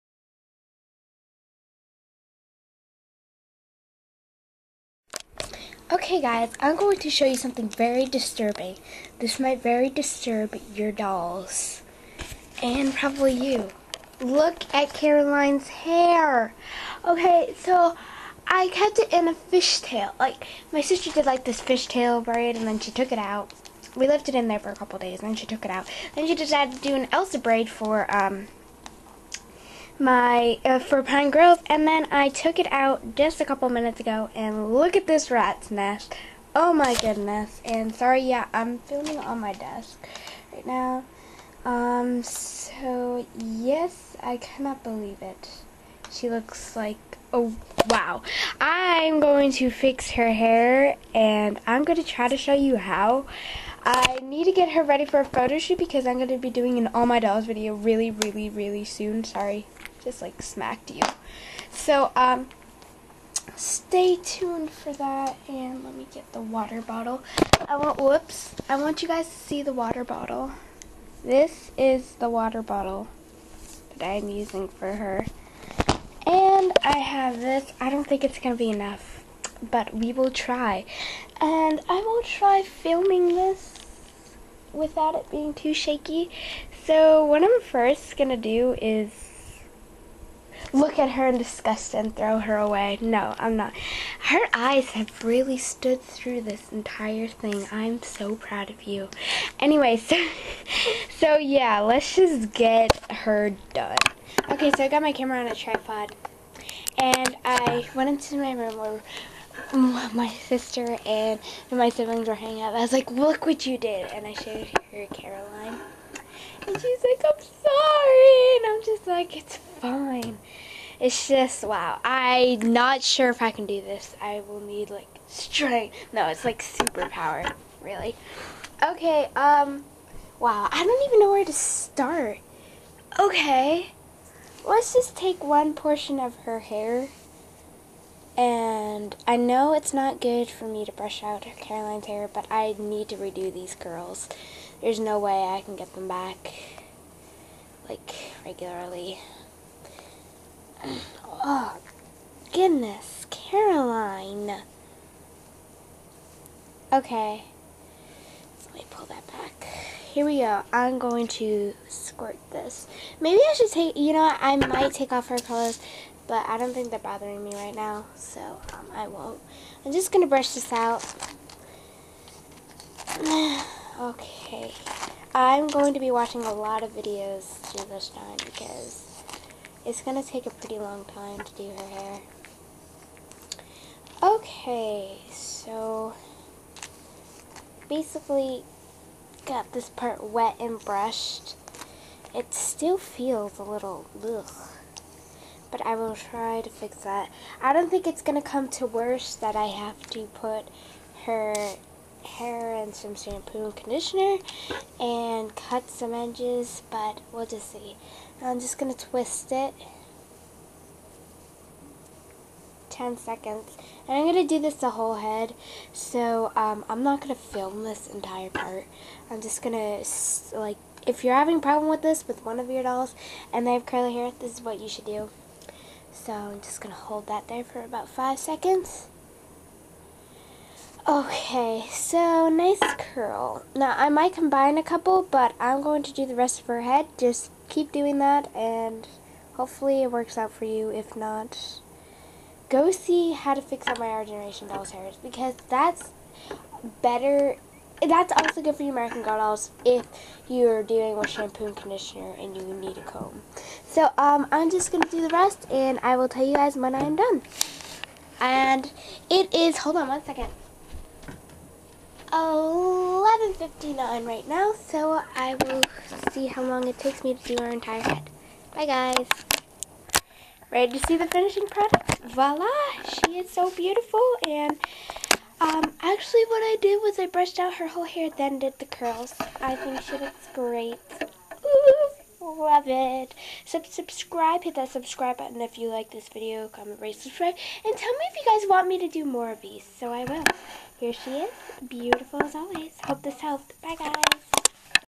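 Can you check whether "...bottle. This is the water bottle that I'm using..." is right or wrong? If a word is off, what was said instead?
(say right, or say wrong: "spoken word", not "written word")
right.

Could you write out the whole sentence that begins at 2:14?
Let's just take one portion of her hair.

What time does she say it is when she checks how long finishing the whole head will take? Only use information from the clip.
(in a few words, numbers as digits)
11:59.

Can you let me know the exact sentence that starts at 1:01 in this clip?
So, um, stay tuned for that.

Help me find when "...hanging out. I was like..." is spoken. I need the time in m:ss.
1:52.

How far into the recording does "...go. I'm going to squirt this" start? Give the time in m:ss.
2:40.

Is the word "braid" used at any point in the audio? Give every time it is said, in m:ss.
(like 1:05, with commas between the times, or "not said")
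0:22, 0:27.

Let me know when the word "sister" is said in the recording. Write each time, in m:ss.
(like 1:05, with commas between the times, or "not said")
0:20, 1:50.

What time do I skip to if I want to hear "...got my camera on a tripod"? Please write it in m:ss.
1:44.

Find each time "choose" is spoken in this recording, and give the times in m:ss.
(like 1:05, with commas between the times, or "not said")
not said.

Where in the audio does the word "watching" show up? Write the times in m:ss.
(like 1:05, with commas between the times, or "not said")
2:56.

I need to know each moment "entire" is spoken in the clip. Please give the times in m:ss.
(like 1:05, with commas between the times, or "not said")
1:36, 3:38, 4:27.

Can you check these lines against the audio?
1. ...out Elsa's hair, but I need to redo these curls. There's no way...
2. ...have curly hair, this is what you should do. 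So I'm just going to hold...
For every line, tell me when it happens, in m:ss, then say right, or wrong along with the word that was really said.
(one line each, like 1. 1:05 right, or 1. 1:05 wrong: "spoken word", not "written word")
1. 2:21 wrong: "Caroline", not "Elsa"
2. 3:43 right.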